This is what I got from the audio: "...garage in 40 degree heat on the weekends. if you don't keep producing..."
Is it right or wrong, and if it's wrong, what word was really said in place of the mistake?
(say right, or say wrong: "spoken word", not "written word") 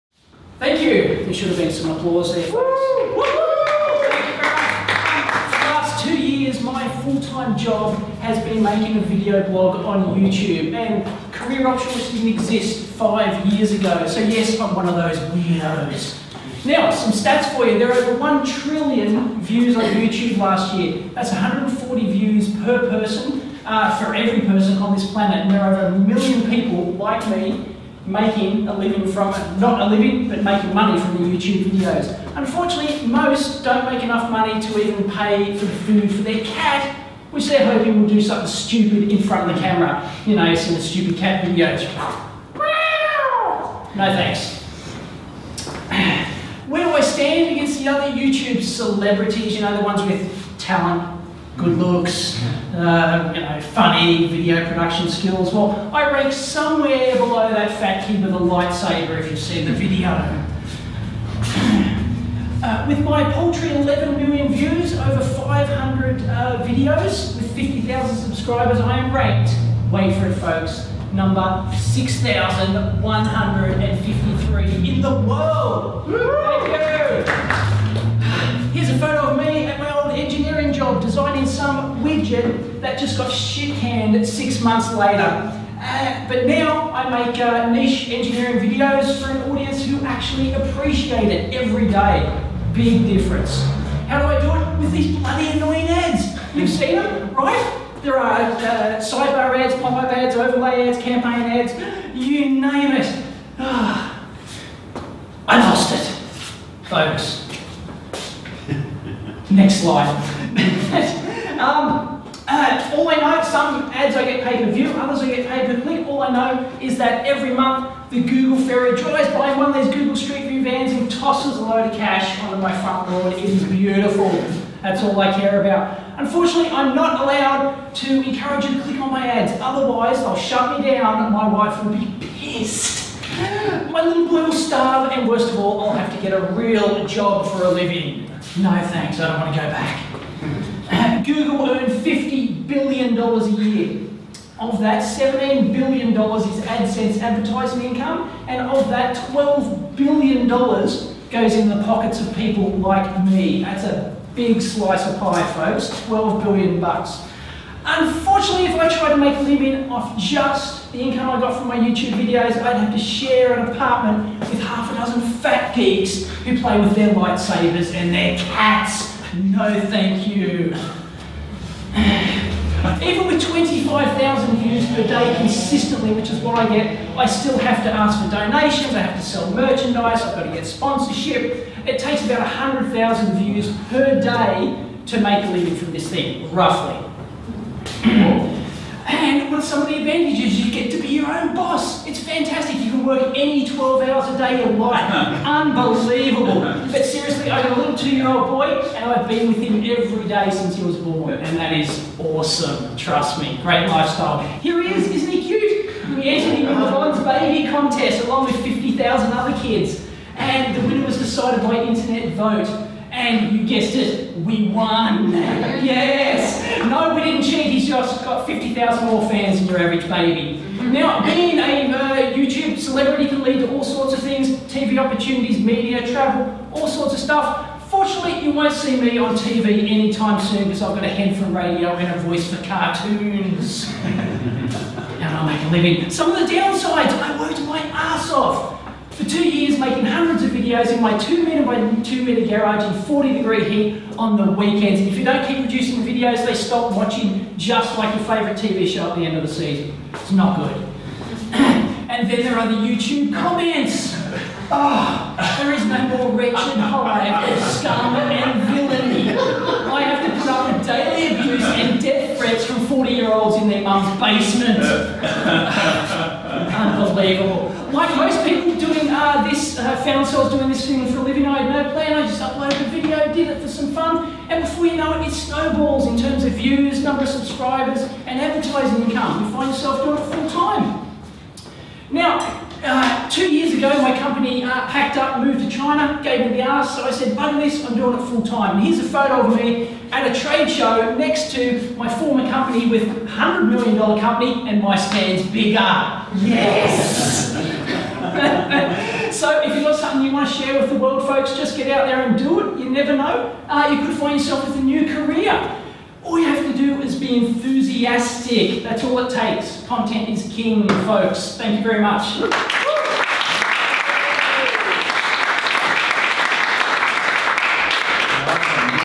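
right.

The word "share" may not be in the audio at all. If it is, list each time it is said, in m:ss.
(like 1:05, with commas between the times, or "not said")
2:42, 5:00.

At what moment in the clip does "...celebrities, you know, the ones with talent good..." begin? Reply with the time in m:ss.
0:48.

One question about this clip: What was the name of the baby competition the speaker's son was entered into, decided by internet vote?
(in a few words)
Bond's Baby Contest.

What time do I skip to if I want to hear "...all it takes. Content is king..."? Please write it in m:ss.
5:09.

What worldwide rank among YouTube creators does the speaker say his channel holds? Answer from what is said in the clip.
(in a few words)
6,153.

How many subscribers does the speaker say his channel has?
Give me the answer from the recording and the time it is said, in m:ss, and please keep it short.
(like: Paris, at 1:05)
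50,000, at 1:07.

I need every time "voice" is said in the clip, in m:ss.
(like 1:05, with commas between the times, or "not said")
3:52.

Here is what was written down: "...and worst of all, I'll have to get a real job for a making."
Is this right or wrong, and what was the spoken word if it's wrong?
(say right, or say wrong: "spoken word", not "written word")
wrong: "living", not "making".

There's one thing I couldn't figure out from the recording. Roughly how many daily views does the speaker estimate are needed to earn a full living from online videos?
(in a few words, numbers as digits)
100,000.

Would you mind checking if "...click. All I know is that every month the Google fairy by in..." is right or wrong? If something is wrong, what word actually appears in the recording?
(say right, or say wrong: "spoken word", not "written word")
right.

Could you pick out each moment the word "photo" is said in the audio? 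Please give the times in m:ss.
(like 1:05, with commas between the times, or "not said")
1:18, 4:49.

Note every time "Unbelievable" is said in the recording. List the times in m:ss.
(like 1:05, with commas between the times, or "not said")
3:15, 4:26.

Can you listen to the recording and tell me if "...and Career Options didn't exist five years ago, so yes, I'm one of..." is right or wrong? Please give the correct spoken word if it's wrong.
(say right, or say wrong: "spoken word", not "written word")
right.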